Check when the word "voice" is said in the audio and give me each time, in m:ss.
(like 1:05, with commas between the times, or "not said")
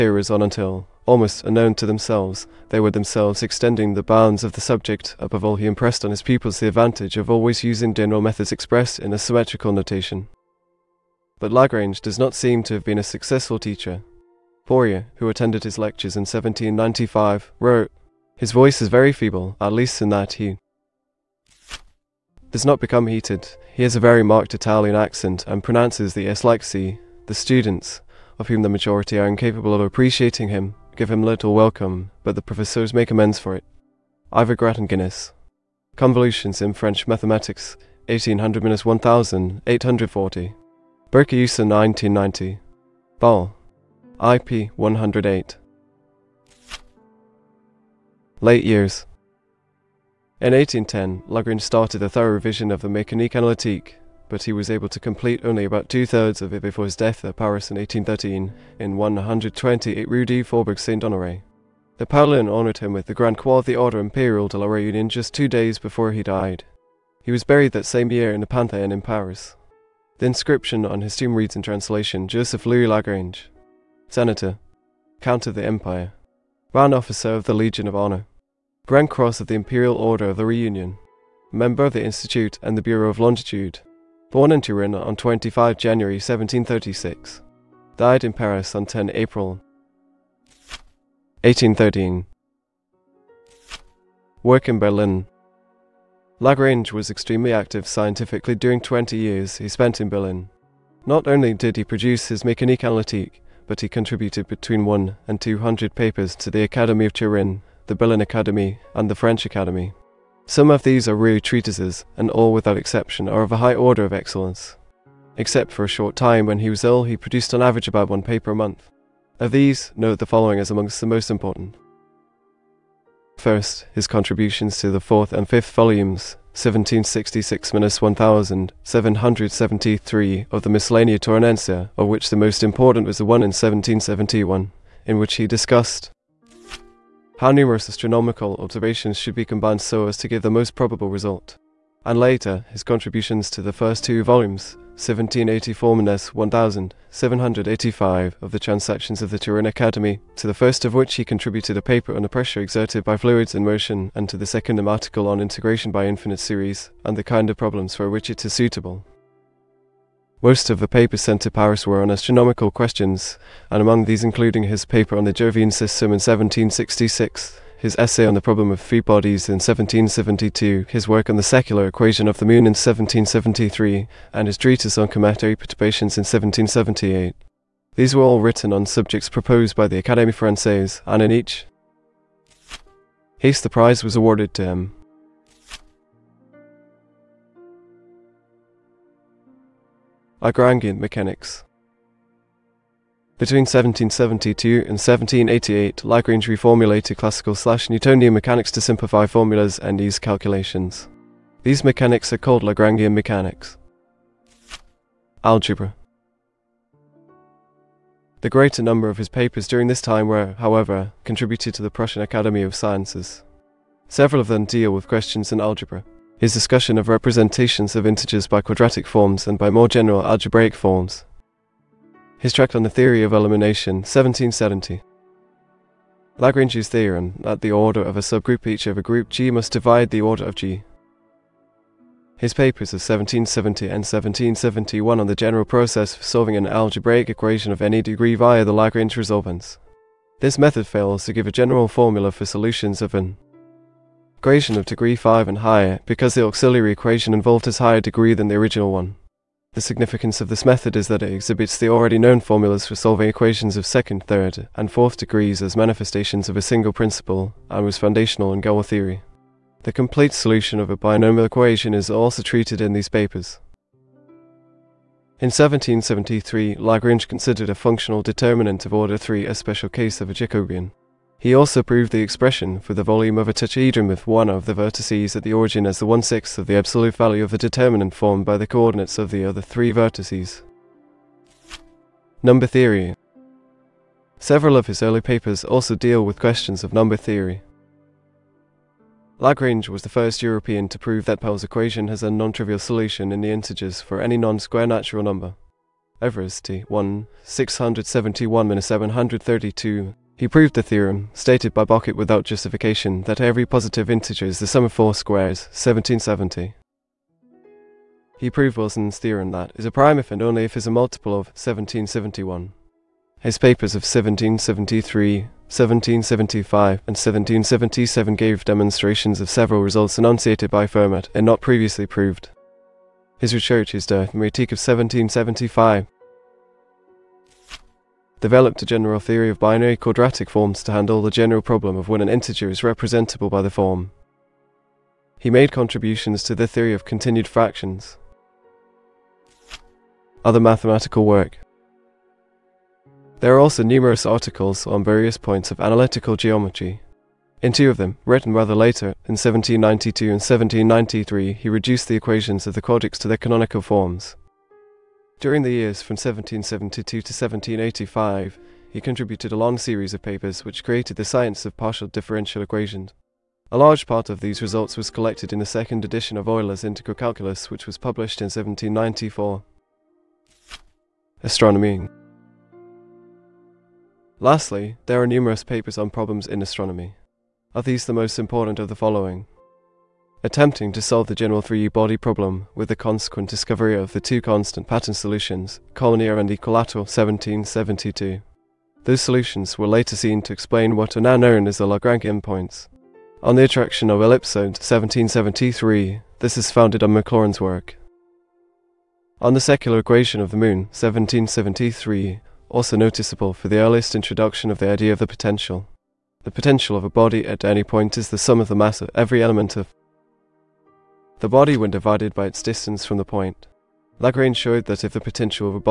0:18.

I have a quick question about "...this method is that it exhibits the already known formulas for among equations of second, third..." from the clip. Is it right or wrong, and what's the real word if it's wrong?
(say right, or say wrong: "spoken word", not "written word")
wrong: "solving", not "among".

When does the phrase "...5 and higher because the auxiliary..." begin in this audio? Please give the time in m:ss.
4:05.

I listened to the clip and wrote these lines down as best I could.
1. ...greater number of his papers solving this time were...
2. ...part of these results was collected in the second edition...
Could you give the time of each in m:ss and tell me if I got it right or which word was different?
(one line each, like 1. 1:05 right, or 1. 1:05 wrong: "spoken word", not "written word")
1. 3:28 wrong: "during", not "solving"
2. 6:04 right.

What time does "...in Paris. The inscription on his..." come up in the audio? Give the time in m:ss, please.
1:08.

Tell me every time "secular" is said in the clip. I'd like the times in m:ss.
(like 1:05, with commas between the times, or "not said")
2:51, 6:39.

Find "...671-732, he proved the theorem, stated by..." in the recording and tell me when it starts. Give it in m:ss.
4:57.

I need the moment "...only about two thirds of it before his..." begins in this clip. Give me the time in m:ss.
0:55.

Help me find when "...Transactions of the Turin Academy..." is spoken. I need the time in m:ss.
2:28.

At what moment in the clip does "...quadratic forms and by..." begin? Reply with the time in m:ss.
3:38.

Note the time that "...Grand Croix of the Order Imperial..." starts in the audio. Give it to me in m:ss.
1:03.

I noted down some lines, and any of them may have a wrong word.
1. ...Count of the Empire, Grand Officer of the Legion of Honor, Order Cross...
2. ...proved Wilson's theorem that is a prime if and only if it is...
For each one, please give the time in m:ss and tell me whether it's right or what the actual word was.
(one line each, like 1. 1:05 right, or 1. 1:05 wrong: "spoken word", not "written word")
1. 1:15 wrong: "Grand", not "Order"
2. 5:08 right.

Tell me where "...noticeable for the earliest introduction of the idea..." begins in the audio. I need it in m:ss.
6:42.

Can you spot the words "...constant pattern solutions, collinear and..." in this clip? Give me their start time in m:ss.
6:24.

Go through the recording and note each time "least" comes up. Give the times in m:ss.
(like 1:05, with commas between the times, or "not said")
0:19.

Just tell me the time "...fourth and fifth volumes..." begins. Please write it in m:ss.
2:04.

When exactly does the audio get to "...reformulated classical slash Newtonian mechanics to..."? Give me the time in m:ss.
3:16.